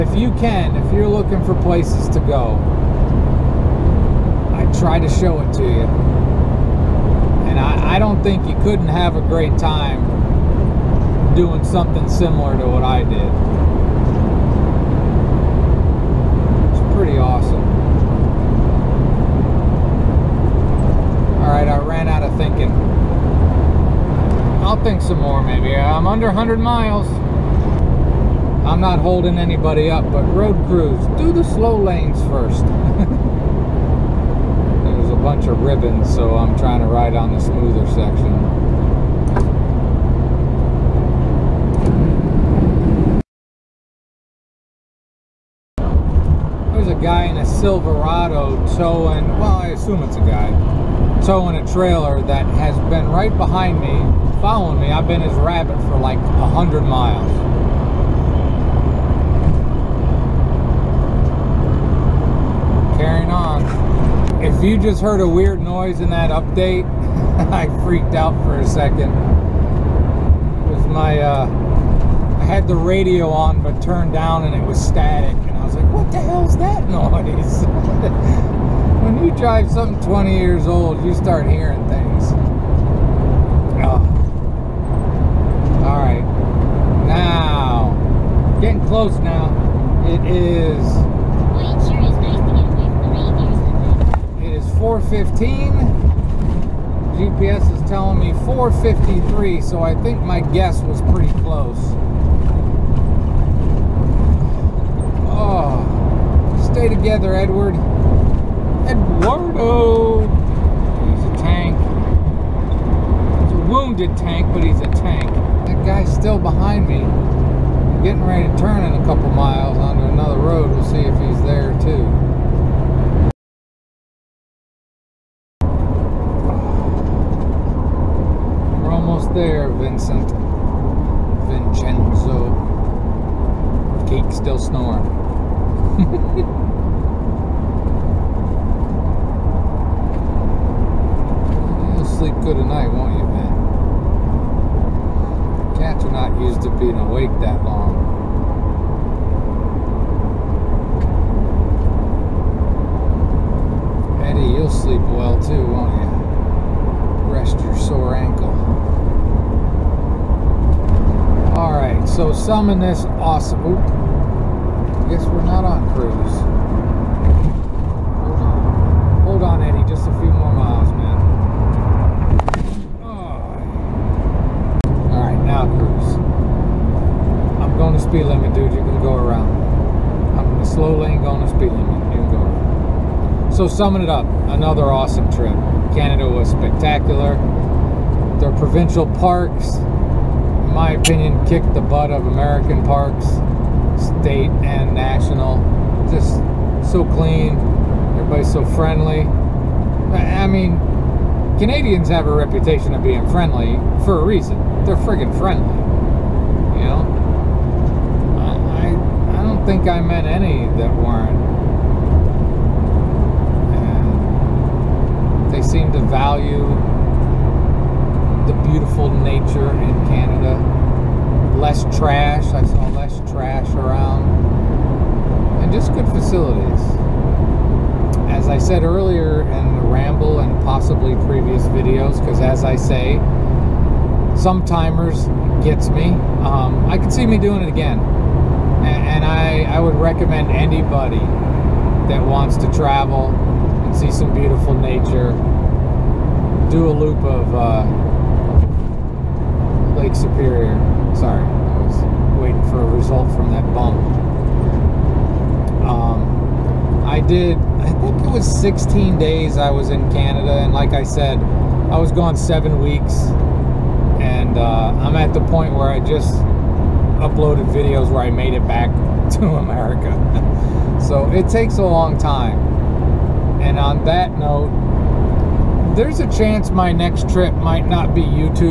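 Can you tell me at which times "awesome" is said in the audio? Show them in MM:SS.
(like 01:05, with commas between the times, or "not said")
00:17, 02:43, 03:04.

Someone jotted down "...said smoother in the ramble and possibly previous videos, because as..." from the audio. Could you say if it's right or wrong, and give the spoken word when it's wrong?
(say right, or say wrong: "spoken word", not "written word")
wrong: "earlier", not "smoother".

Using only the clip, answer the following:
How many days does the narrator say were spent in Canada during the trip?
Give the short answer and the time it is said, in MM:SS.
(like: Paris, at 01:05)
16, at 04:18.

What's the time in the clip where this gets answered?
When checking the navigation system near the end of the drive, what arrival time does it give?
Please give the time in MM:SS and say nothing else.
01:38.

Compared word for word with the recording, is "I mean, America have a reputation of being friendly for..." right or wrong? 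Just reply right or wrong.
wrong.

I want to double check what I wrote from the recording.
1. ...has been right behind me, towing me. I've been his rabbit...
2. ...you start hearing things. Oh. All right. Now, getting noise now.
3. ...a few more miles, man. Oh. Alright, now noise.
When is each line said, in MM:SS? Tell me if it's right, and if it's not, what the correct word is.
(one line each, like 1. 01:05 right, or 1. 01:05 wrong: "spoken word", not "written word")
1. 00:52 wrong: "following", not "towing"
2. 01:21 wrong: "close", not "noise"
3. 02:50 wrong: "cruise", not "noise".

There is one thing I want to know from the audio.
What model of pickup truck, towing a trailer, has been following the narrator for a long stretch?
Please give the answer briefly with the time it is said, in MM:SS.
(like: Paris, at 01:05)
Silverado, at 00:47.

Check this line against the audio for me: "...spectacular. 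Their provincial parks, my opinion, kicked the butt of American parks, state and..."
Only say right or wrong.
right.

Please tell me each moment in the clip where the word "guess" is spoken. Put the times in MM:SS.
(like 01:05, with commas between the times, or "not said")
01:40, 02:45.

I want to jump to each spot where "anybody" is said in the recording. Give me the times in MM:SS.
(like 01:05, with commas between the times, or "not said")
00:29, 04:00.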